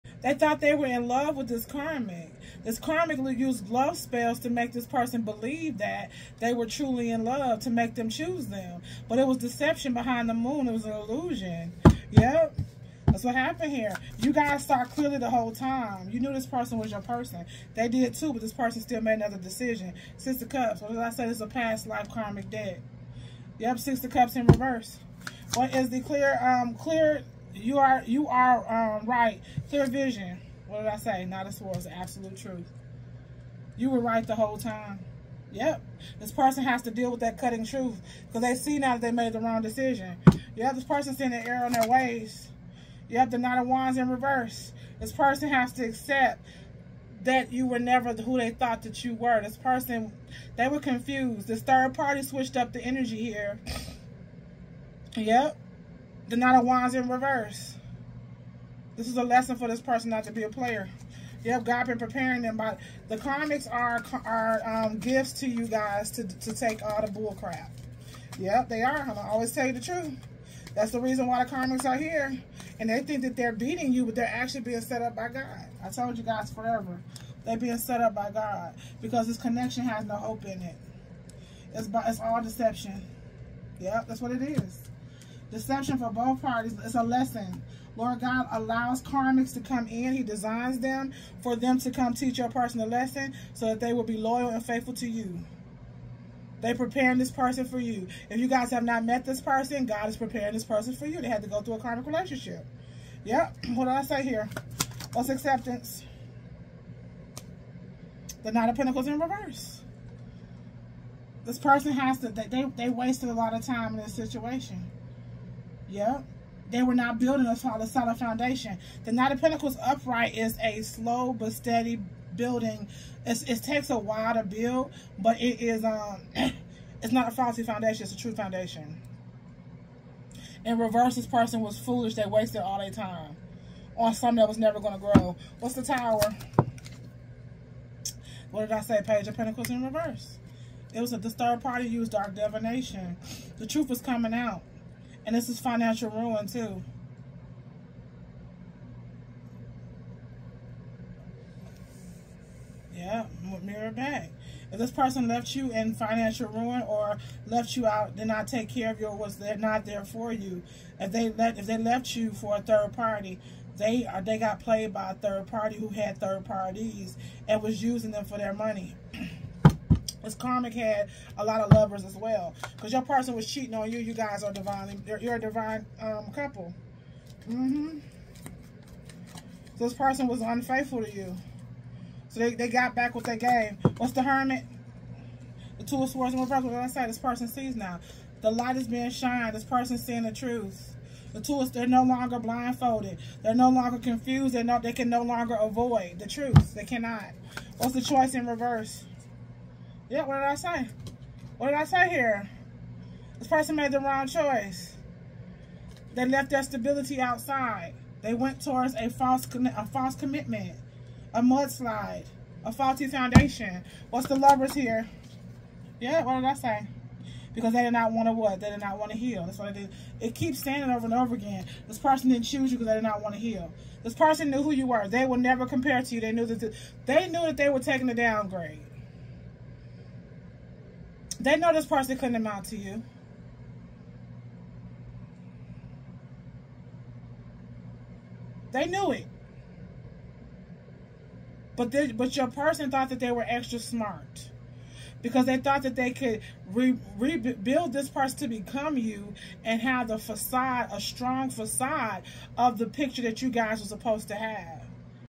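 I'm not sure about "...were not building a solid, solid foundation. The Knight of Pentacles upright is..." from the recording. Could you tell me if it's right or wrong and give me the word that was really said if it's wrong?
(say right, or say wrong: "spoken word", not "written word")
right.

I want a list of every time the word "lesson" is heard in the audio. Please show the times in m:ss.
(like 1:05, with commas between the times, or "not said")
0:59, 1:27, 1:32.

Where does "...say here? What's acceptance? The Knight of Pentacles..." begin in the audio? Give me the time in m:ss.
1:44.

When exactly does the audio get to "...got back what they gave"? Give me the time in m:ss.
3:02.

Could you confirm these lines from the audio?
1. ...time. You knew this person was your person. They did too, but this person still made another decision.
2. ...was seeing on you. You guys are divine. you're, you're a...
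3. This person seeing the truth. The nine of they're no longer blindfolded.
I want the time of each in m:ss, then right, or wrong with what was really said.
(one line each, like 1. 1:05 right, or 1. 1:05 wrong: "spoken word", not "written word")
1. 0:15 right
2. 2:53 wrong: "cheating", not "seeing"
3. 3:09 wrong: "two", not "nine".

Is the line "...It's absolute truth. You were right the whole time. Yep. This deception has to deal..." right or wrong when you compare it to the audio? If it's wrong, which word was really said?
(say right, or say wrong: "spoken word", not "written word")
wrong: "person", not "deception".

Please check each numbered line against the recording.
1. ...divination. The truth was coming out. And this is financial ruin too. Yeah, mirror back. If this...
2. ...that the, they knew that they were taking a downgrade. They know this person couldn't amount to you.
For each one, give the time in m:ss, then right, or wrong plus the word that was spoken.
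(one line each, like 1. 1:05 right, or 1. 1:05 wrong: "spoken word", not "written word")
1. 2:22 right
2. 3:46 right.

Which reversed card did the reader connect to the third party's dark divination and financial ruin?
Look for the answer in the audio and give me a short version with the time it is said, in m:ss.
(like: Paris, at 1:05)
Page of Pentacles, at 2:19.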